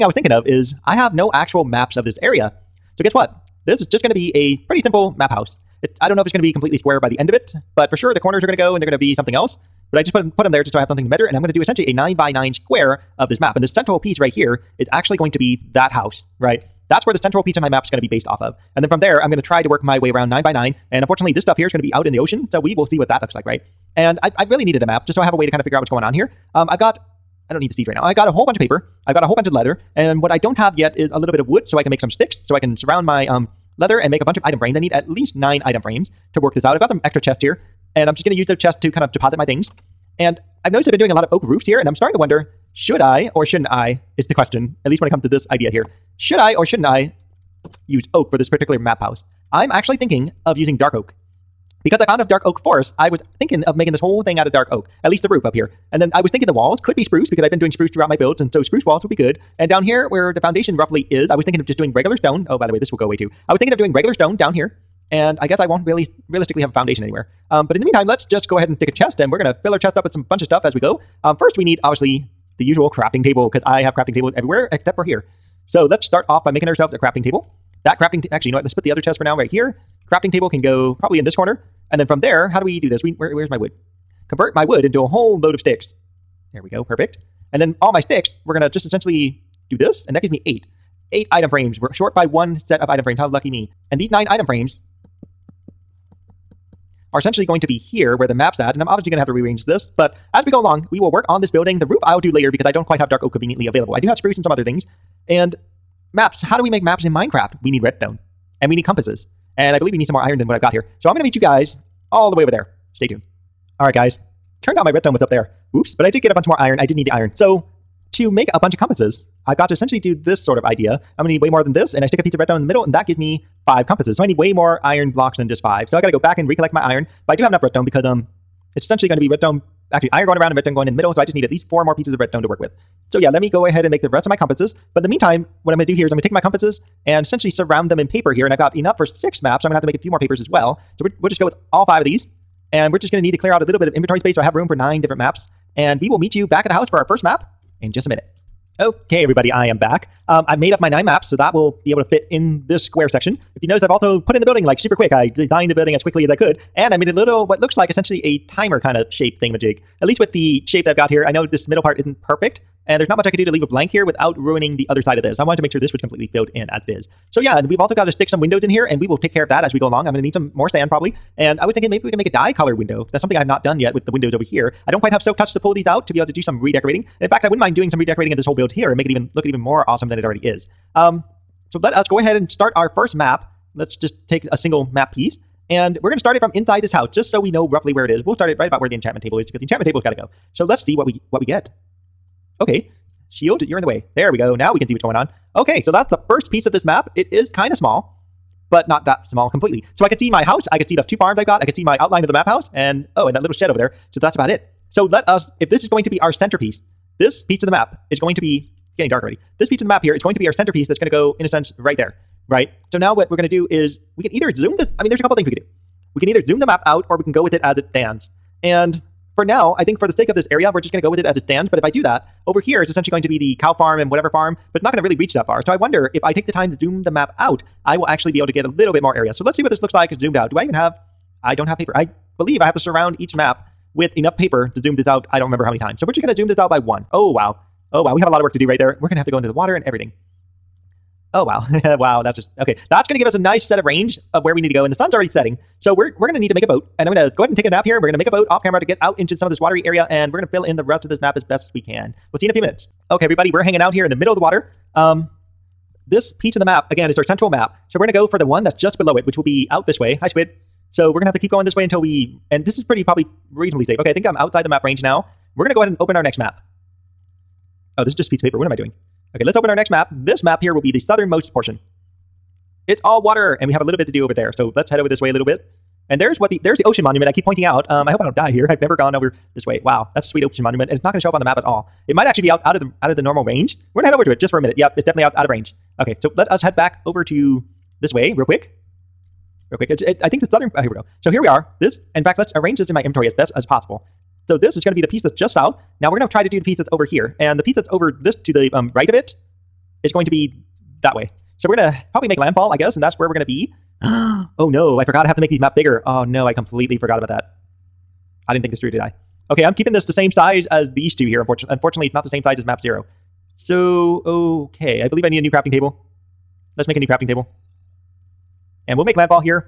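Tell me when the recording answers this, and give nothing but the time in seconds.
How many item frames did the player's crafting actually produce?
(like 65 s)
91 s.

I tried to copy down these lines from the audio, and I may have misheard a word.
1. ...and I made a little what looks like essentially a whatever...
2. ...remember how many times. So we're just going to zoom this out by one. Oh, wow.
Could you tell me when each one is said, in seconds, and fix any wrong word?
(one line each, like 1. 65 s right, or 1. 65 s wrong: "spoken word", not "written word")
1. 156 s wrong: "timer", not "whatever"
2. 235 s right.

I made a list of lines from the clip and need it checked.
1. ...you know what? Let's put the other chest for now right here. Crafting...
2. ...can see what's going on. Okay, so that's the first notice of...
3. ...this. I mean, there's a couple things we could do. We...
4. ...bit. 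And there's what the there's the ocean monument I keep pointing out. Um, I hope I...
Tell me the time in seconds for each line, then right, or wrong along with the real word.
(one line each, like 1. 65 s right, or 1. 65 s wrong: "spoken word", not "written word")
1. 78 s right
2. 194 s wrong: "piece", not "notice"
3. 214 s right
4. 275 s right.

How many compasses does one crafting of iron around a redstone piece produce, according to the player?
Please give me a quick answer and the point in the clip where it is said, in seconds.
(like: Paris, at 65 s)
5, at 123 s.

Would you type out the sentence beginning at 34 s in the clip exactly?
I need at least nine item frames to work this out.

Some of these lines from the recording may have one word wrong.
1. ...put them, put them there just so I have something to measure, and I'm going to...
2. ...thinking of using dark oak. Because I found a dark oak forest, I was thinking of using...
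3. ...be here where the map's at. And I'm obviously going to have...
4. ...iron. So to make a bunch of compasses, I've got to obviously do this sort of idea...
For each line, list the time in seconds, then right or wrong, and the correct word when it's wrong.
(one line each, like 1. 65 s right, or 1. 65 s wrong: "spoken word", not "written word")
1. 10 s right
2. 49 s wrong: "making", not "using"
3. 97 s right
4. 117 s wrong: "essentially", not "obviously".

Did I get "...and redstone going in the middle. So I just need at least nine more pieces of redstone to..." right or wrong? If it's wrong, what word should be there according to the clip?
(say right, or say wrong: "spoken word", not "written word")
wrong: "four", not "nine".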